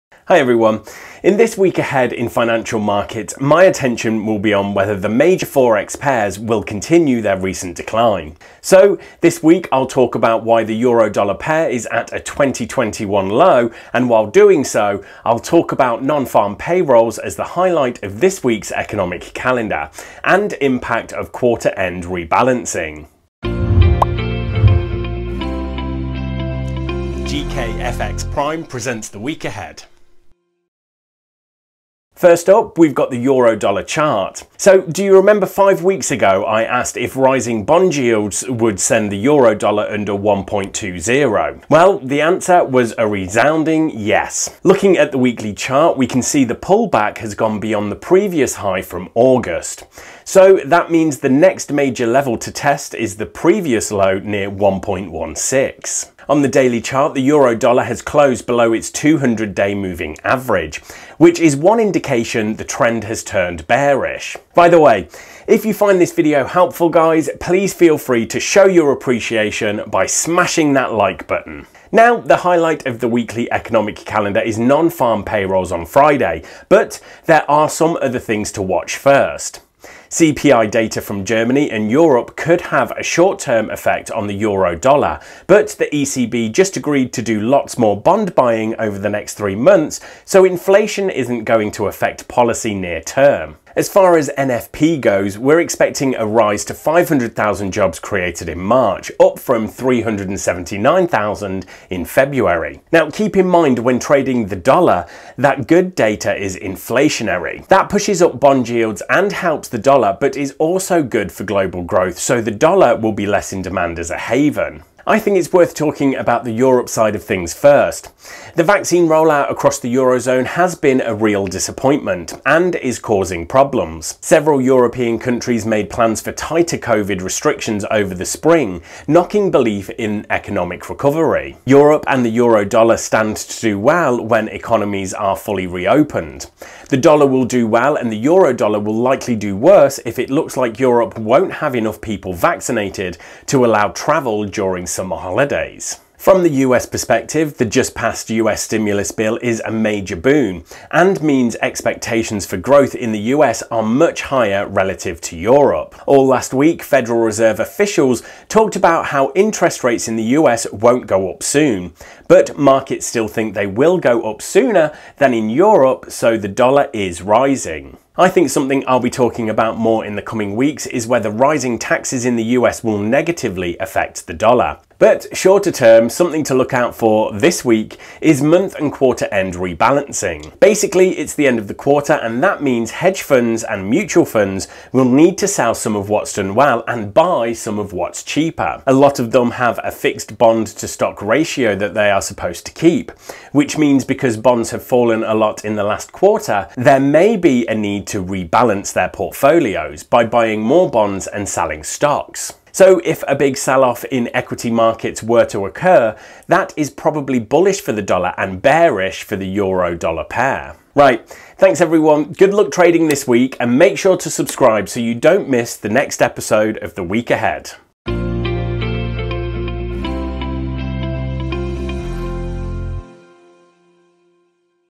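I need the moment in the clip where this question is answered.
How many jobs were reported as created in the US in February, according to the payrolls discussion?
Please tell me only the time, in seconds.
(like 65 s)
99 s.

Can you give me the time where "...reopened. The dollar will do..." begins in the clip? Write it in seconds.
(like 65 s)
135 s.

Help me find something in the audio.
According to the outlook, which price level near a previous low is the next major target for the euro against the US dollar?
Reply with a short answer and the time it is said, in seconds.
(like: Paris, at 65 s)
1.16, at 54 s.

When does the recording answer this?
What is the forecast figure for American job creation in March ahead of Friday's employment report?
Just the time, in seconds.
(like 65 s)
96 s.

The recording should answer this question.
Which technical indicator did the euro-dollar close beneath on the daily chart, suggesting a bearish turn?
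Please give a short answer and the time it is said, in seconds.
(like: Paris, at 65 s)
200 day moving average, at 58 s.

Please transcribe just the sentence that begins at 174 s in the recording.
But shorter term, something to look out for this week is month and quarter end rebalancing.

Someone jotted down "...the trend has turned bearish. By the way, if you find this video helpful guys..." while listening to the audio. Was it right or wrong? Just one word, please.
right.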